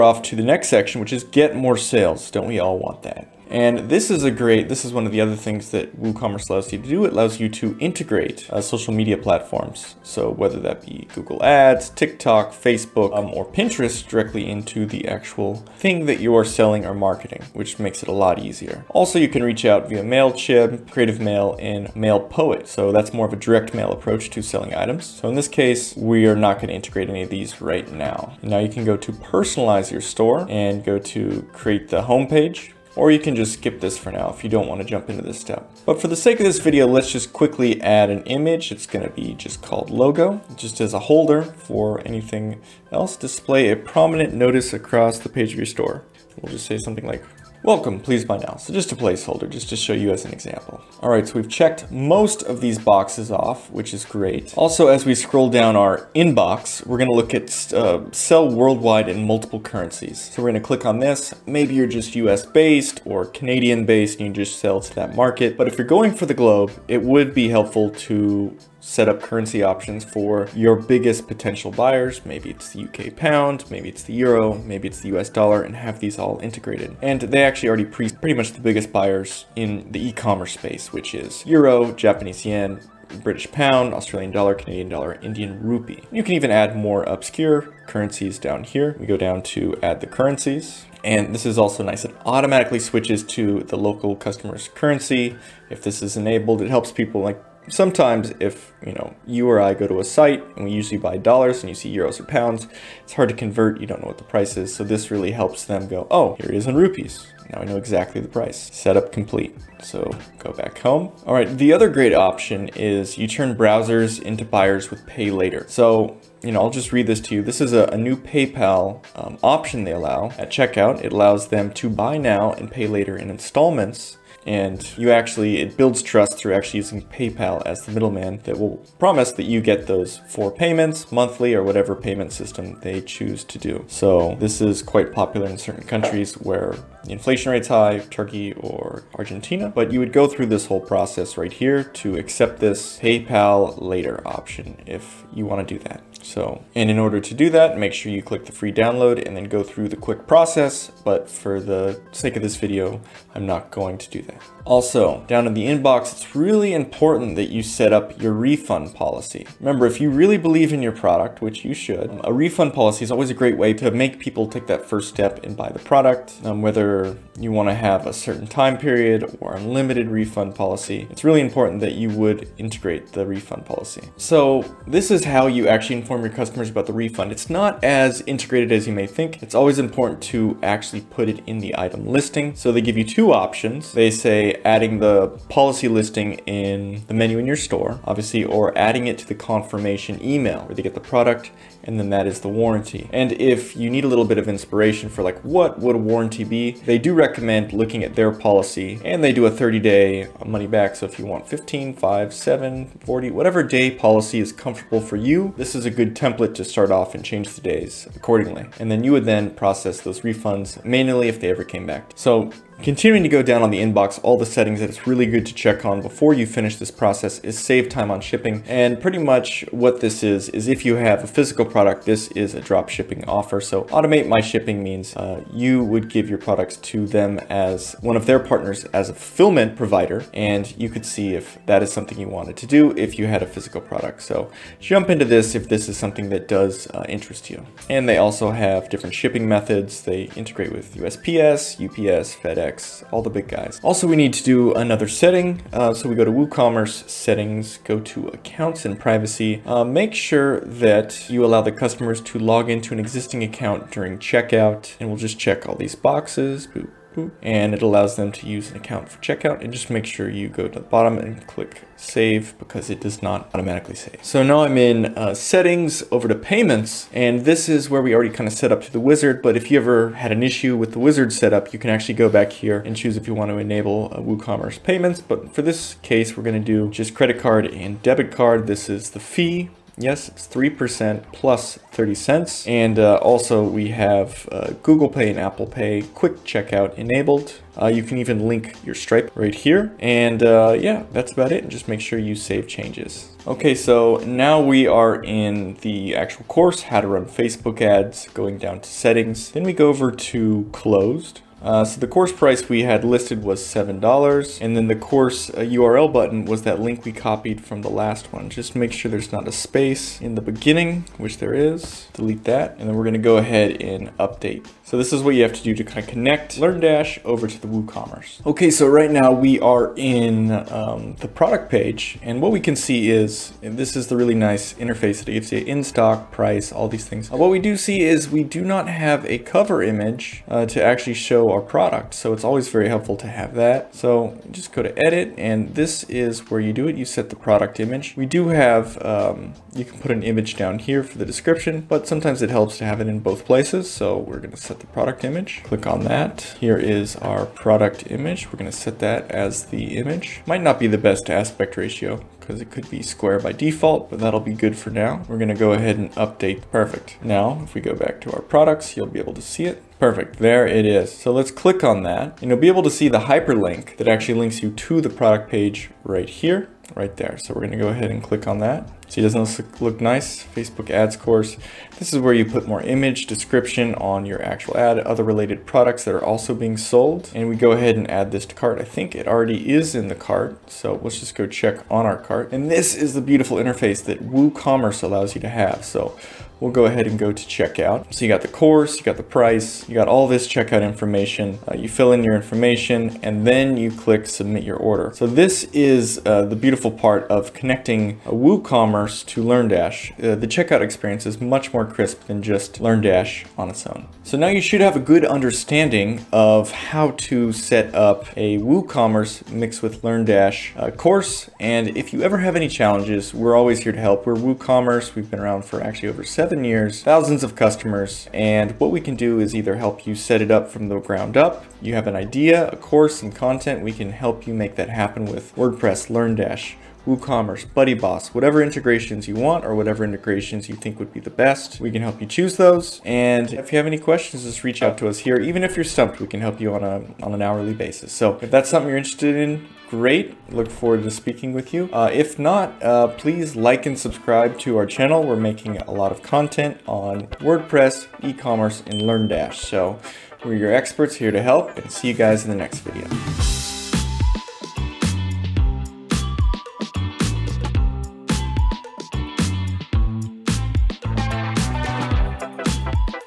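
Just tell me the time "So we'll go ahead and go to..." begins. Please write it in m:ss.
6:25.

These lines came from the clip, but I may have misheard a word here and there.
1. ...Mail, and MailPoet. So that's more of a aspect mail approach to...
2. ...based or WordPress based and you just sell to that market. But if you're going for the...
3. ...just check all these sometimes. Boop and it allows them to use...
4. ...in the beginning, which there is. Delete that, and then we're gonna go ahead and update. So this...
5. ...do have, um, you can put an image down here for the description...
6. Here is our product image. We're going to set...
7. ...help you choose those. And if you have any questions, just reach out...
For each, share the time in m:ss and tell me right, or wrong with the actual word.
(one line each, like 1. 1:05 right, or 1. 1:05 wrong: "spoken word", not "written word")
1. 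0:21 wrong: "direct", not "aspect"
2. 1:02 wrong: "Canadian", not "WordPress"
3. 4:15 wrong: "boxes", not "sometimes"
4. 5:10 right
5. 5:38 right
6. 5:46 right
7. 7:12 right.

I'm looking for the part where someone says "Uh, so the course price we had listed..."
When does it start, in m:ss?
5:01.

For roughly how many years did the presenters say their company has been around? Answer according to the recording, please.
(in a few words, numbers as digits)
Over 7 years.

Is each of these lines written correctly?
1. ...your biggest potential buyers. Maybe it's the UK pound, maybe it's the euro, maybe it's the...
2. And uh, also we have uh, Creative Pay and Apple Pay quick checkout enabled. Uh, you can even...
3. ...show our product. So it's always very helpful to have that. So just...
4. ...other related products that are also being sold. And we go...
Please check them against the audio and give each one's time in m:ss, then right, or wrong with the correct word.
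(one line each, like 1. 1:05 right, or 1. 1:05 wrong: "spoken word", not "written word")
1. 1:10 right
2. 4:42 wrong: "Google", not "Creative"
3. 5:31 right
4. 6:14 right.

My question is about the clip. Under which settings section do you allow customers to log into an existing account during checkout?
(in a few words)
Accounts and privacy.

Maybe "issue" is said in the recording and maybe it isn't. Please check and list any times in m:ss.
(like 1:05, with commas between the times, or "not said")
4:30.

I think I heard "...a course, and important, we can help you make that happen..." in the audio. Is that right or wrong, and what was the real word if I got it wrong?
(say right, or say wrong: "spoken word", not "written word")
wrong: "content", not "important".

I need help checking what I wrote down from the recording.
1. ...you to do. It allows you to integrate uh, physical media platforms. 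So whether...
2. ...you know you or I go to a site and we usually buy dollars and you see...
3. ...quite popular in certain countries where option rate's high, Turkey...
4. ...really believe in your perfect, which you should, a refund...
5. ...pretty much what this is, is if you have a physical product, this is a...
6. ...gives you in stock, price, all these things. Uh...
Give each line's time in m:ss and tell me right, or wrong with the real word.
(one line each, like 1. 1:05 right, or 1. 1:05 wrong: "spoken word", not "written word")
1. 0:06 wrong: "social", not "physical"
2. 1:38 right
3. 2:14 wrong: "inflation", not "option"
4. 2:40 wrong: "product", not "perfect"
5. 3:38 right
6. 5:25 right.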